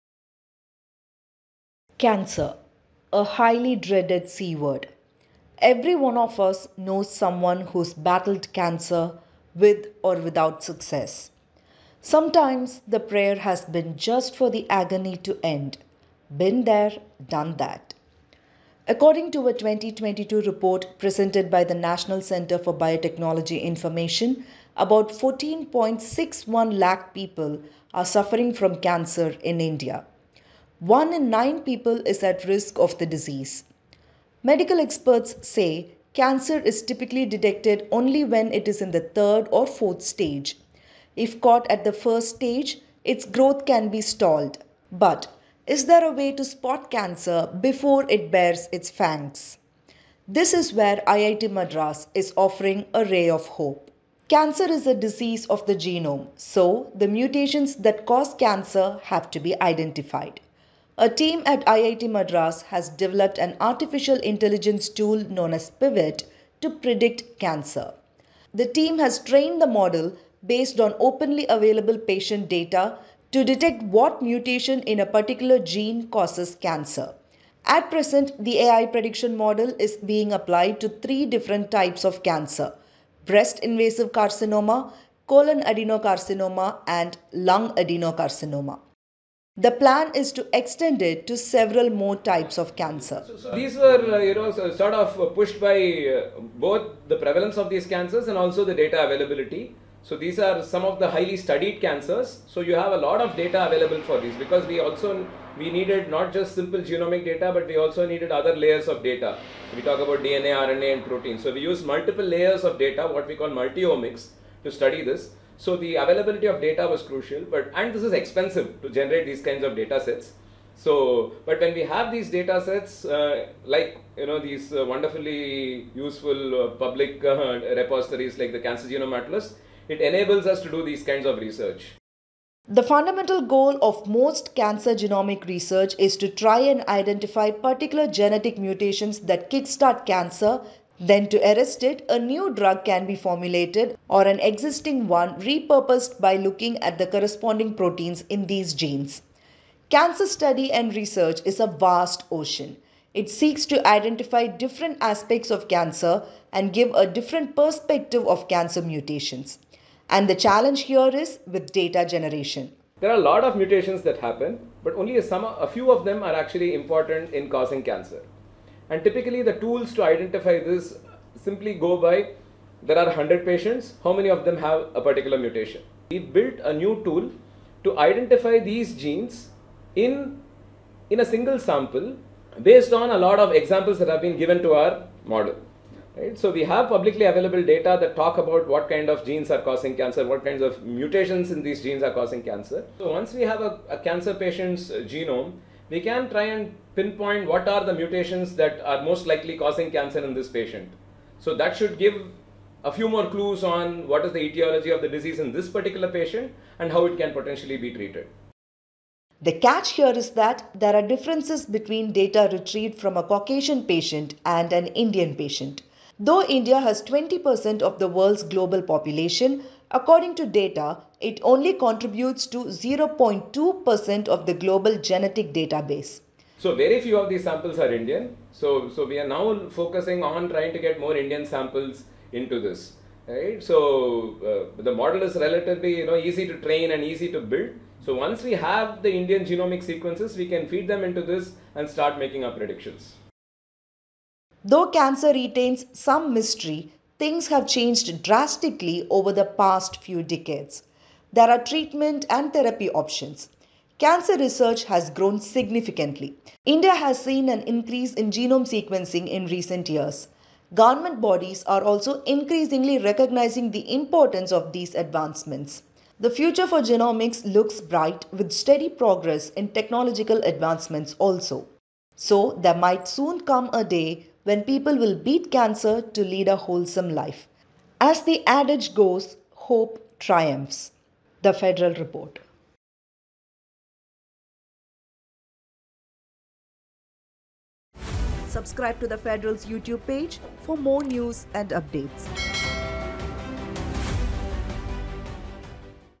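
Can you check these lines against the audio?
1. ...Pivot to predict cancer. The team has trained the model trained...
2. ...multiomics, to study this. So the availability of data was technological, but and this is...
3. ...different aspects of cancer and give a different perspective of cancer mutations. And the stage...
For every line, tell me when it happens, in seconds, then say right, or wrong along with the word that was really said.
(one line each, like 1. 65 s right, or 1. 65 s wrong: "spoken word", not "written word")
1. 65 s wrong: "based", not "trained"
2. 113 s wrong: "crucial", not "technological"
3. 154 s wrong: "challenge", not "stage".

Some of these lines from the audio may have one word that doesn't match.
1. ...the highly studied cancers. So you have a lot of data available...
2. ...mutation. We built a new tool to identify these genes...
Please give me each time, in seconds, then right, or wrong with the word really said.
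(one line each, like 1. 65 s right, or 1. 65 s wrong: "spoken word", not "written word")
1. 100 s right
2. 175 s right.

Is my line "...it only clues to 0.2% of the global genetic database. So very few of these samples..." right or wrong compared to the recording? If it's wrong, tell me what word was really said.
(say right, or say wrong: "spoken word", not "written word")
wrong: "contributes", not "clues".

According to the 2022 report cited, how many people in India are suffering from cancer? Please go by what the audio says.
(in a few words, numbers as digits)
14.61 lakh.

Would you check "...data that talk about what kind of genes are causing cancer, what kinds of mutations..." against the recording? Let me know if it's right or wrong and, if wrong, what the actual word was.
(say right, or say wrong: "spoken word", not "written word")
right.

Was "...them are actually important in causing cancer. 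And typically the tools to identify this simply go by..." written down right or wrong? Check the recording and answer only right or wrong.
right.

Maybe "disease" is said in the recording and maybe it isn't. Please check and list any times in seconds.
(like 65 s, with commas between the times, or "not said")
33 s, 54 s, 205 s.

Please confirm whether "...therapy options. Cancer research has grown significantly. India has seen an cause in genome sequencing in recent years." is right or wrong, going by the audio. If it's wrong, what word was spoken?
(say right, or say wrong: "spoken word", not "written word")
wrong: "increase", not "cause".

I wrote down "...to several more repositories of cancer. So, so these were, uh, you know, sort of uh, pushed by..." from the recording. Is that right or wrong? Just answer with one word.
wrong.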